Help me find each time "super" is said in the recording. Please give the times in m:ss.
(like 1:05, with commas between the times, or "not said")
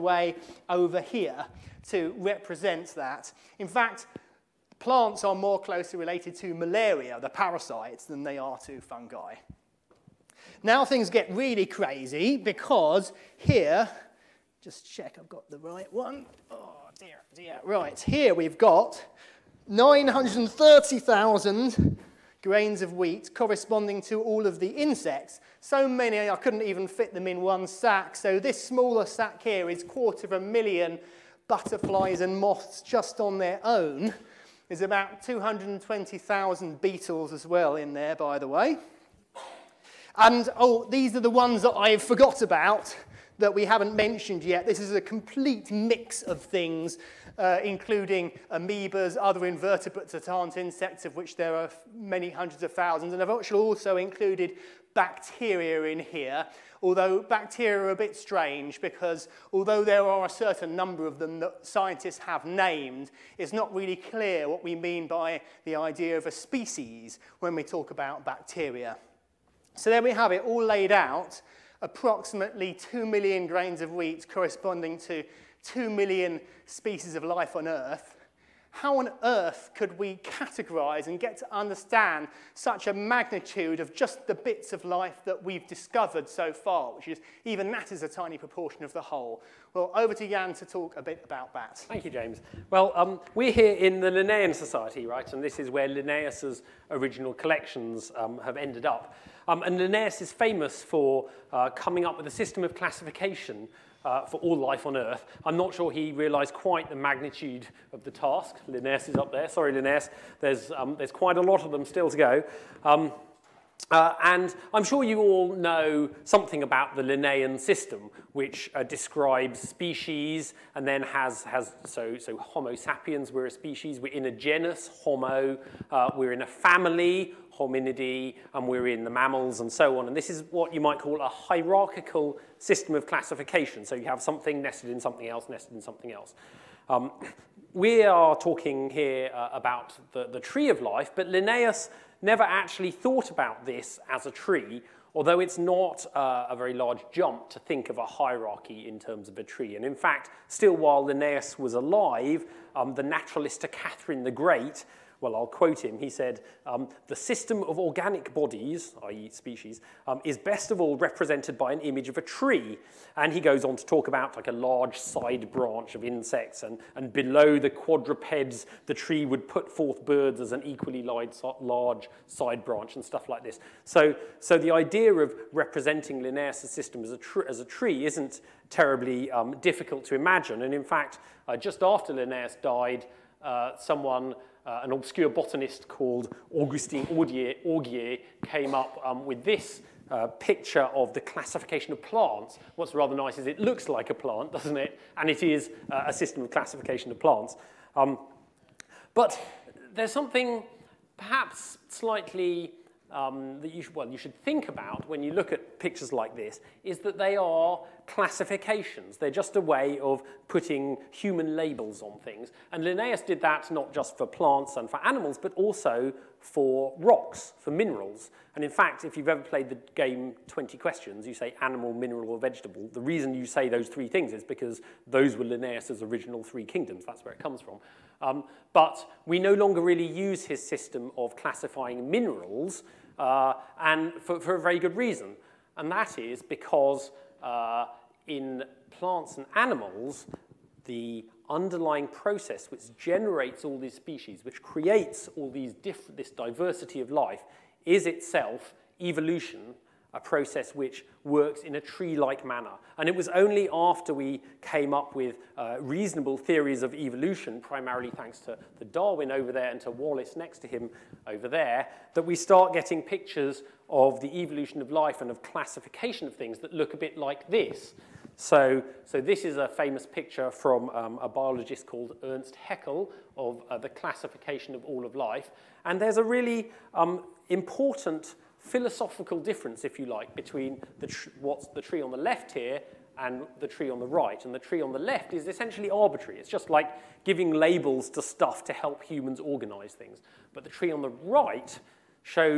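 not said.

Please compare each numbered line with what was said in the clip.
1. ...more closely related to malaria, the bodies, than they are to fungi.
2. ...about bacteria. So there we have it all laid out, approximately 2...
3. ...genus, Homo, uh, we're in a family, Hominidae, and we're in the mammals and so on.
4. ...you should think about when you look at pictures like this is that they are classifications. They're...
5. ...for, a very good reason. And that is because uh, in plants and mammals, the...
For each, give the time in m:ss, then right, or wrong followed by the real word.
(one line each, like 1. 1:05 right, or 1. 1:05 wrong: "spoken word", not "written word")
1. 0:05 wrong: "parasites", not "bodies"
2. 1:07 right
3. 2:04 right
4. 3:24 right
5. 3:54 wrong: "animals", not "mammals".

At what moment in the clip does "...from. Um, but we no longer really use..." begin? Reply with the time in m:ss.
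3:47.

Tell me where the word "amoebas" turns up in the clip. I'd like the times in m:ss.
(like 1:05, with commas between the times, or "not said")
0:48.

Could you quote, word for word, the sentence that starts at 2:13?
So you have something nested in something else, nested in something else.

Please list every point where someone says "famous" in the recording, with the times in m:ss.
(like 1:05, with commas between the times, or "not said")
1:40, 4:29.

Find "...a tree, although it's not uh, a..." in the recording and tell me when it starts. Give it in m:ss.
2:24.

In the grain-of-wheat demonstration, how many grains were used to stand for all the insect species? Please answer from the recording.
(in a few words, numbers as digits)
930,000.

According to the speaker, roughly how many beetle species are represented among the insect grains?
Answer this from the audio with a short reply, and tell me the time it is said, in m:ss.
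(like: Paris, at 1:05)
220,000, at 0:35.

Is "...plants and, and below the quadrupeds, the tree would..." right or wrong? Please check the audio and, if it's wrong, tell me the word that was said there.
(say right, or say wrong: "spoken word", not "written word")
wrong: "insects", not "plants".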